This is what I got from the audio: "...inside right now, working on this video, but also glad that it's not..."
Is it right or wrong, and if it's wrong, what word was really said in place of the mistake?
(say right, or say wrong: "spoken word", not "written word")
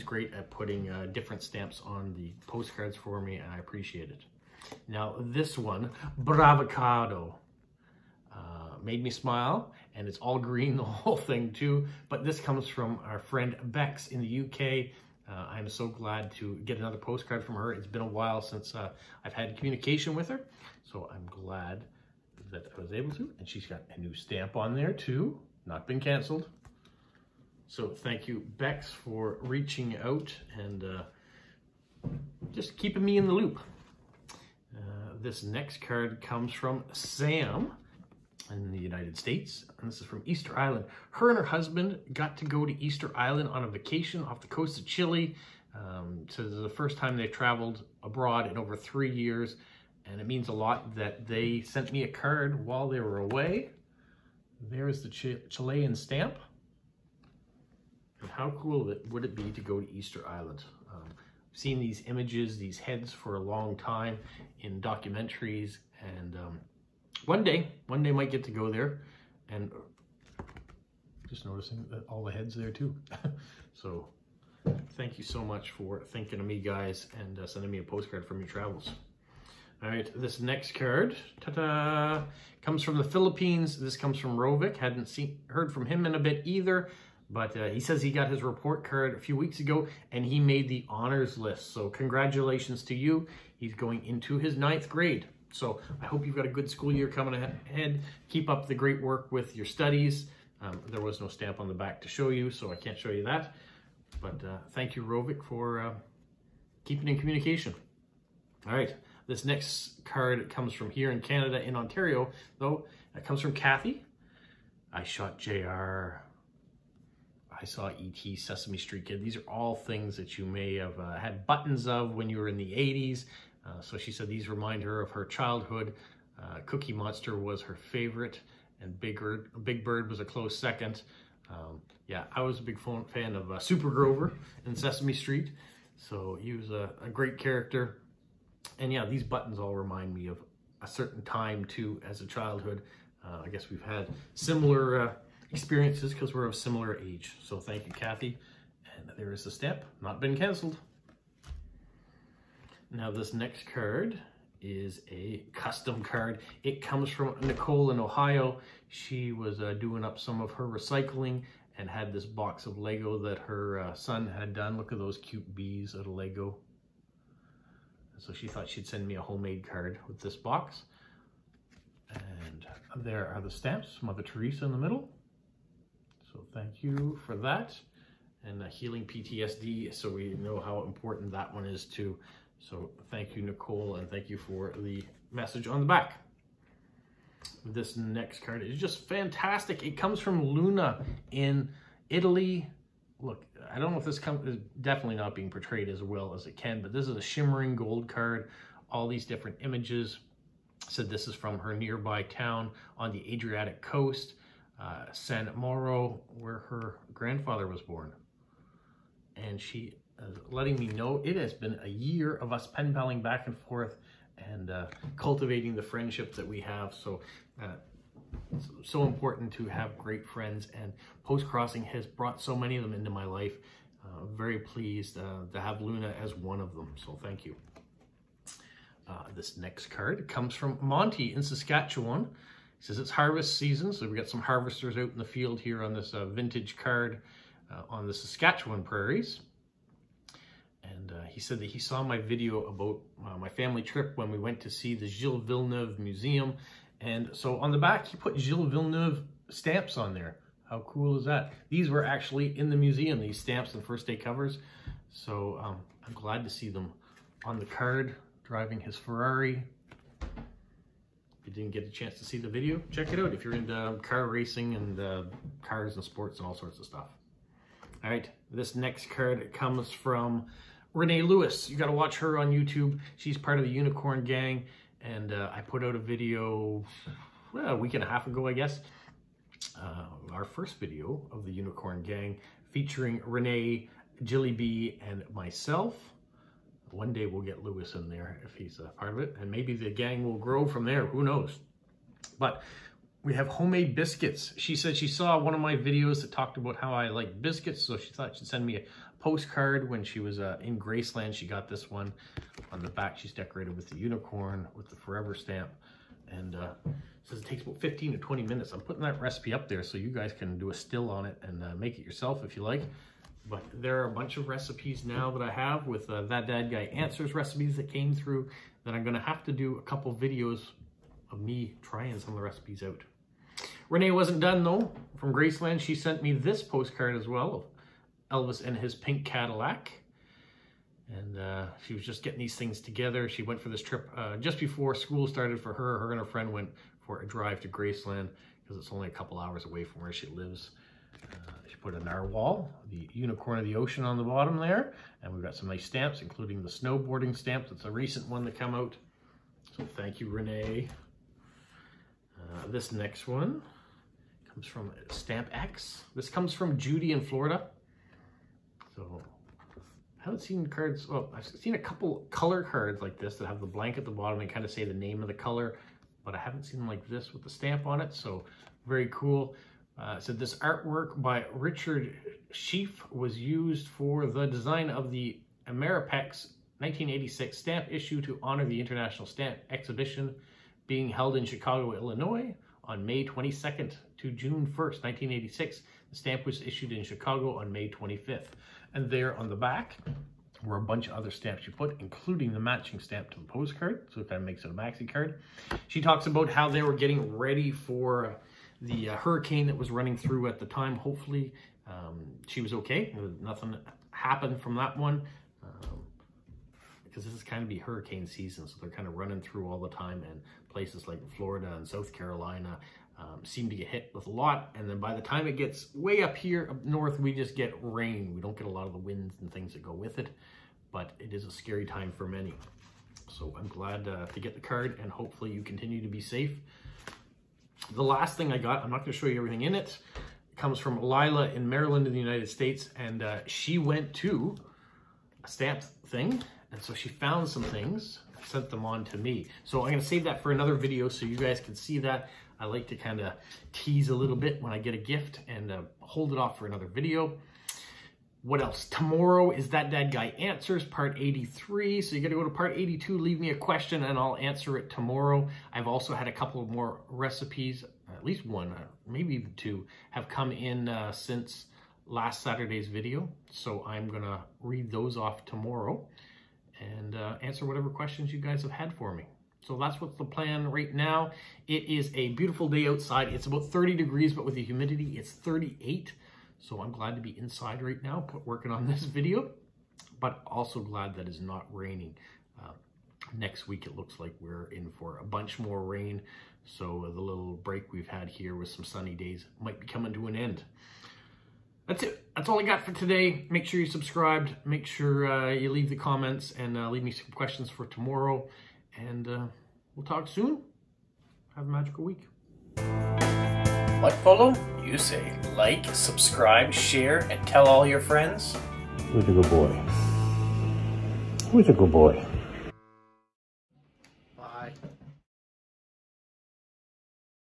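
right.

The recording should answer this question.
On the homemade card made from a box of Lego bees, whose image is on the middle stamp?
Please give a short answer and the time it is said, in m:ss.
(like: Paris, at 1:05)
Mother Teresa, at 2:54.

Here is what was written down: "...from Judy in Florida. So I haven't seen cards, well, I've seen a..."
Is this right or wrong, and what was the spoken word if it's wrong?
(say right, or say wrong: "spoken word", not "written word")
right.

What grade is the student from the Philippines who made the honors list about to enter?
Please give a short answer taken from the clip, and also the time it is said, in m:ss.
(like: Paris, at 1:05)
ninth grade, at 1:34.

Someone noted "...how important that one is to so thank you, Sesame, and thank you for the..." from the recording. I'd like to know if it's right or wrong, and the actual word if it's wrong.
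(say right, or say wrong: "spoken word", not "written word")
wrong: "Nicole", not "Sesame".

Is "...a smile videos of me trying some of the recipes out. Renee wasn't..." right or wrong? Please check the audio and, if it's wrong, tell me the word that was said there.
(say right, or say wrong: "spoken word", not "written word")
wrong: "couple", not "smile".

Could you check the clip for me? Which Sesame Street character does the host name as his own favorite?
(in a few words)
Super Grover.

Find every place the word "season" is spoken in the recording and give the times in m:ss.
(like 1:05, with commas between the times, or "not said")
3:53, 6:48.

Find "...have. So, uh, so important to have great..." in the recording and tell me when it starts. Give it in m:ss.
3:36.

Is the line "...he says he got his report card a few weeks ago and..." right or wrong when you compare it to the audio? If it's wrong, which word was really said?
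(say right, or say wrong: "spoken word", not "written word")
right.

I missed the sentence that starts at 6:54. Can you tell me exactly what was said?
And then by the time it gets way up here up north, we just get rain.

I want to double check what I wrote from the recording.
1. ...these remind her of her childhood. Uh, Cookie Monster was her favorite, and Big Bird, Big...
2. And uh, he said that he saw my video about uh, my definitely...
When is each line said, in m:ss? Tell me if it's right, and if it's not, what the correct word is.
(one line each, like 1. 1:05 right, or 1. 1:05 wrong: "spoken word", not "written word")
1. 2:04 right
2. 4:00 wrong: "family", not "definitely".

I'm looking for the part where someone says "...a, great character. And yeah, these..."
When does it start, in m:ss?
2:17.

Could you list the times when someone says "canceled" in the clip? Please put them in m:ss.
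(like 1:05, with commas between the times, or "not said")
0:25, 2:30.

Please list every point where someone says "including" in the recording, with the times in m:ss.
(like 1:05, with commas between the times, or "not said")
5:46, 6:31.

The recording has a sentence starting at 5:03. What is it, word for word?
She's decorated with the unicorn with the forever stamp.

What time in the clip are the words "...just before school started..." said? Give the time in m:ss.
5:34.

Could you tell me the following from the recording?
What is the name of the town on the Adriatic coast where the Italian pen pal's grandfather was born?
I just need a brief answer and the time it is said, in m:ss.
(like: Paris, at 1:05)
San Mauro, at 3:25.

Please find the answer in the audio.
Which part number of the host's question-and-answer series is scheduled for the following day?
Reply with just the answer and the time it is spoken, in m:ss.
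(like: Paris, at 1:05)
83, at 7:30.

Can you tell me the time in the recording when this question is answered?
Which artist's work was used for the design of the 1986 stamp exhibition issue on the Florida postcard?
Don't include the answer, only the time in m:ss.
6:11.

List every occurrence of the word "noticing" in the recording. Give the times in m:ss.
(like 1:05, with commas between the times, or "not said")
1:11.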